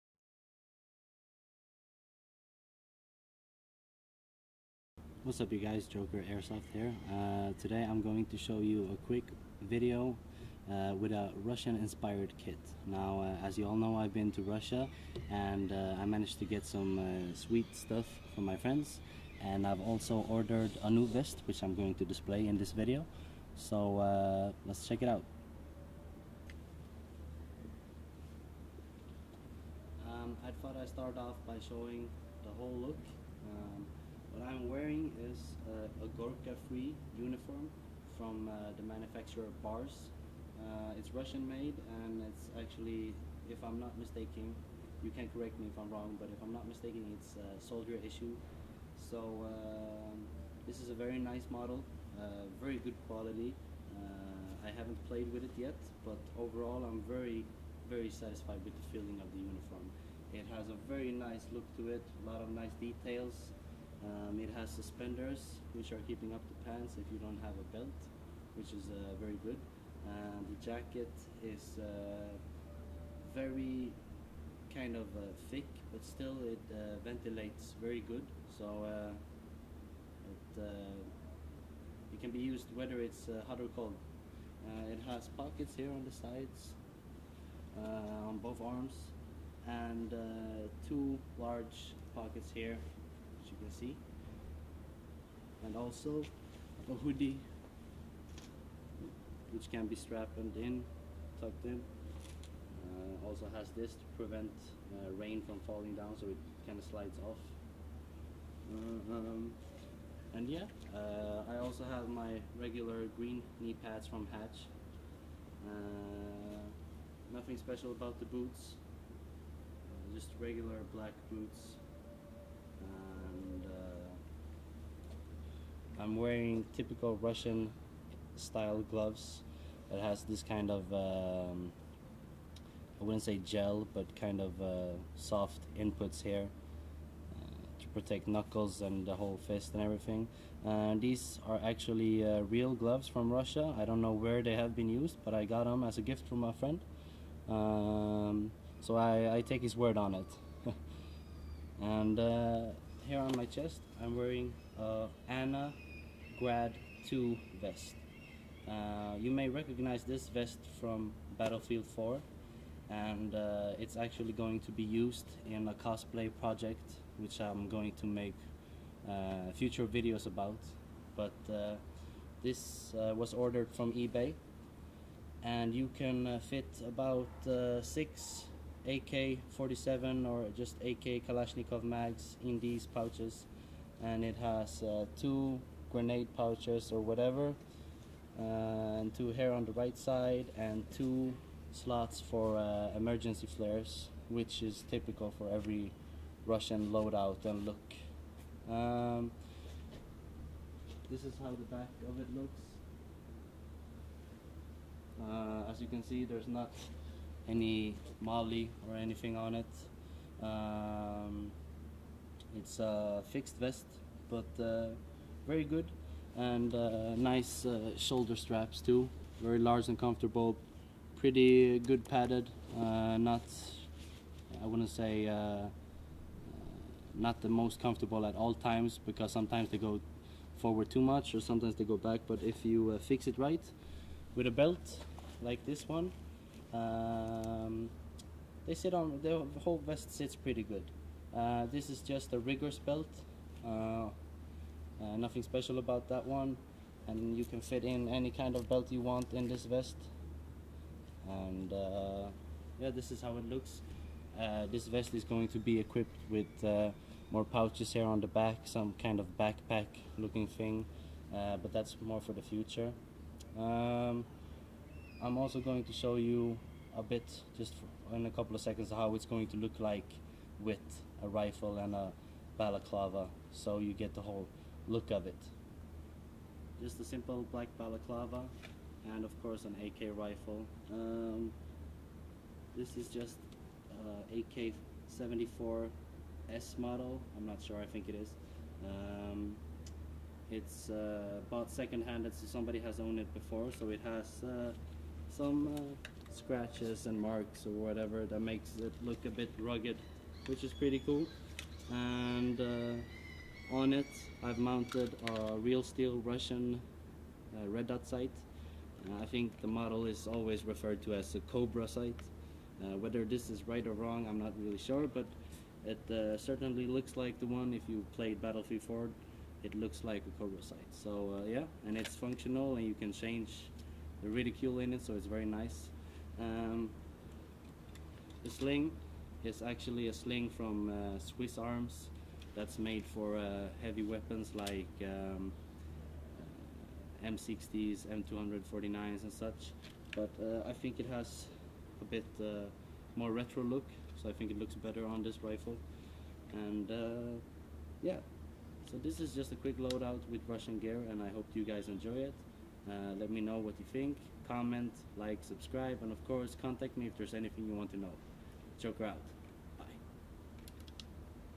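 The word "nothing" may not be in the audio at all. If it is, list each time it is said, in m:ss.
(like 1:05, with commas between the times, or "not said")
1:57, 4:05.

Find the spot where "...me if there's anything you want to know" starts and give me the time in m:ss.
5:56.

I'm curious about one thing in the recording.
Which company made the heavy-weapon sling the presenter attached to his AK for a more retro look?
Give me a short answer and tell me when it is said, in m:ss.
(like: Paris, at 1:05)
Swiss Arms, at 5:31.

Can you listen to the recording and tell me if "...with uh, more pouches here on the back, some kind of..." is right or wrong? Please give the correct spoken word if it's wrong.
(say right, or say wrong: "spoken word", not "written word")
right.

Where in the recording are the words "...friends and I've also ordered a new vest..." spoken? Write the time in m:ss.
0:18.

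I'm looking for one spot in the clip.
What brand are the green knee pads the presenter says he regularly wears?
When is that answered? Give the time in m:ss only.
1:54.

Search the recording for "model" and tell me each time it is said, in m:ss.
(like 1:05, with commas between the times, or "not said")
0:51, 4:46, 5:09.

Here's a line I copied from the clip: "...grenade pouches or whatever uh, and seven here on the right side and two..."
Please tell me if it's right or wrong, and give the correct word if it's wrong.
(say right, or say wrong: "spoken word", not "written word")
wrong: "two", not "seven".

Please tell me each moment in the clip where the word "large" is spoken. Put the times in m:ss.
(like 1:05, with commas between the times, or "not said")
1:31, 3:39.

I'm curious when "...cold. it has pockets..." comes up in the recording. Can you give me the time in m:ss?
1:23.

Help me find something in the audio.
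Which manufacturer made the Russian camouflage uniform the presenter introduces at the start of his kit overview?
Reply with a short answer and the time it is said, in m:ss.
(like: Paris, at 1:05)
Bars, at 0:39.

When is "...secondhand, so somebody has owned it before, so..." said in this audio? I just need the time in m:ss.
4:51.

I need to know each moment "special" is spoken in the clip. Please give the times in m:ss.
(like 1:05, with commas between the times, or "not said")
1:57, 4:05.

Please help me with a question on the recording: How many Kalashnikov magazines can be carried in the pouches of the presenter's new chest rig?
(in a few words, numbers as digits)
6.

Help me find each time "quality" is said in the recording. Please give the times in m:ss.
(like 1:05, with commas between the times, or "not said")
0:53.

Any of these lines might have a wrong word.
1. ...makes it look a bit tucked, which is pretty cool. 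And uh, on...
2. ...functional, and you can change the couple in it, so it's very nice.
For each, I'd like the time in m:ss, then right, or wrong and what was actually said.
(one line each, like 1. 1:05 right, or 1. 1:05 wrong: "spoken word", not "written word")
1. 4:58 wrong: "rugged", not "tucked"
2. 5:22 wrong: "reticle", not "couple".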